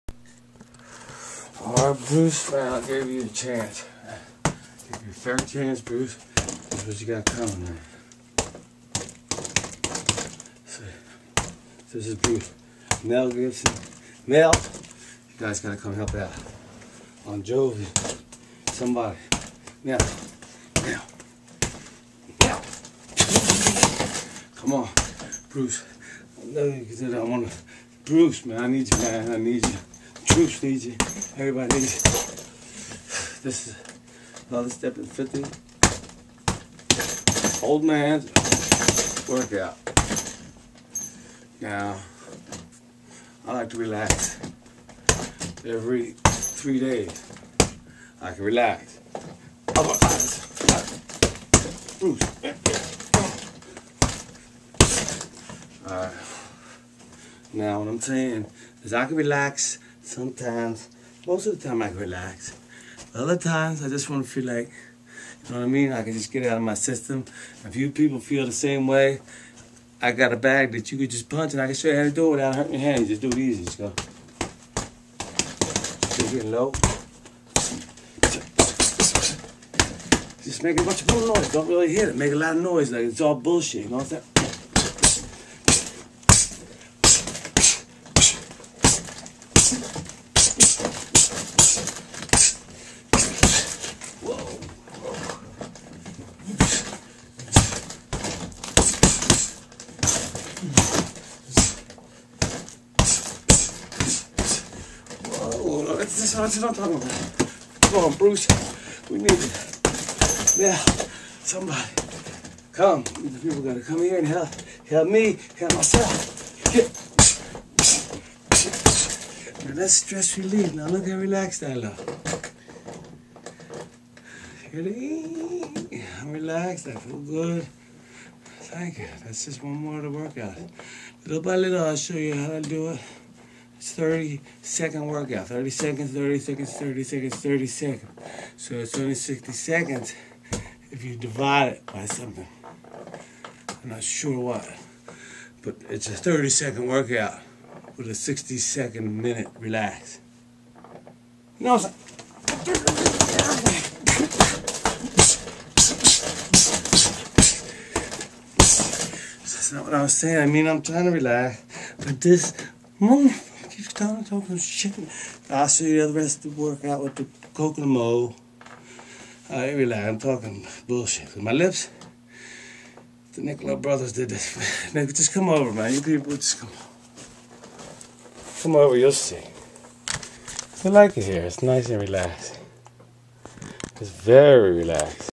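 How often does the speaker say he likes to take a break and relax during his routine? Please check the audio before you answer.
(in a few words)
Every 3 days.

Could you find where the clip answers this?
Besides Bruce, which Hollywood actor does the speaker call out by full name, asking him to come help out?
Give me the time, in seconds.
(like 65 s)
13 s.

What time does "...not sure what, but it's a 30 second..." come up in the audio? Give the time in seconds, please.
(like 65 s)
143 s.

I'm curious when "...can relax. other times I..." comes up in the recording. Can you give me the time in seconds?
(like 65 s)
61 s.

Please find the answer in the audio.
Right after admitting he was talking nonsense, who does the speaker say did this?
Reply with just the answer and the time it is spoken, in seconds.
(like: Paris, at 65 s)
The Nicola brothers, at 173 s.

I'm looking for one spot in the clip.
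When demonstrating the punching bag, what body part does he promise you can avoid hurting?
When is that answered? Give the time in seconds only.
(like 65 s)
72 s.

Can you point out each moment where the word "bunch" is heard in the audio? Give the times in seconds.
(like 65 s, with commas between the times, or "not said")
80 s.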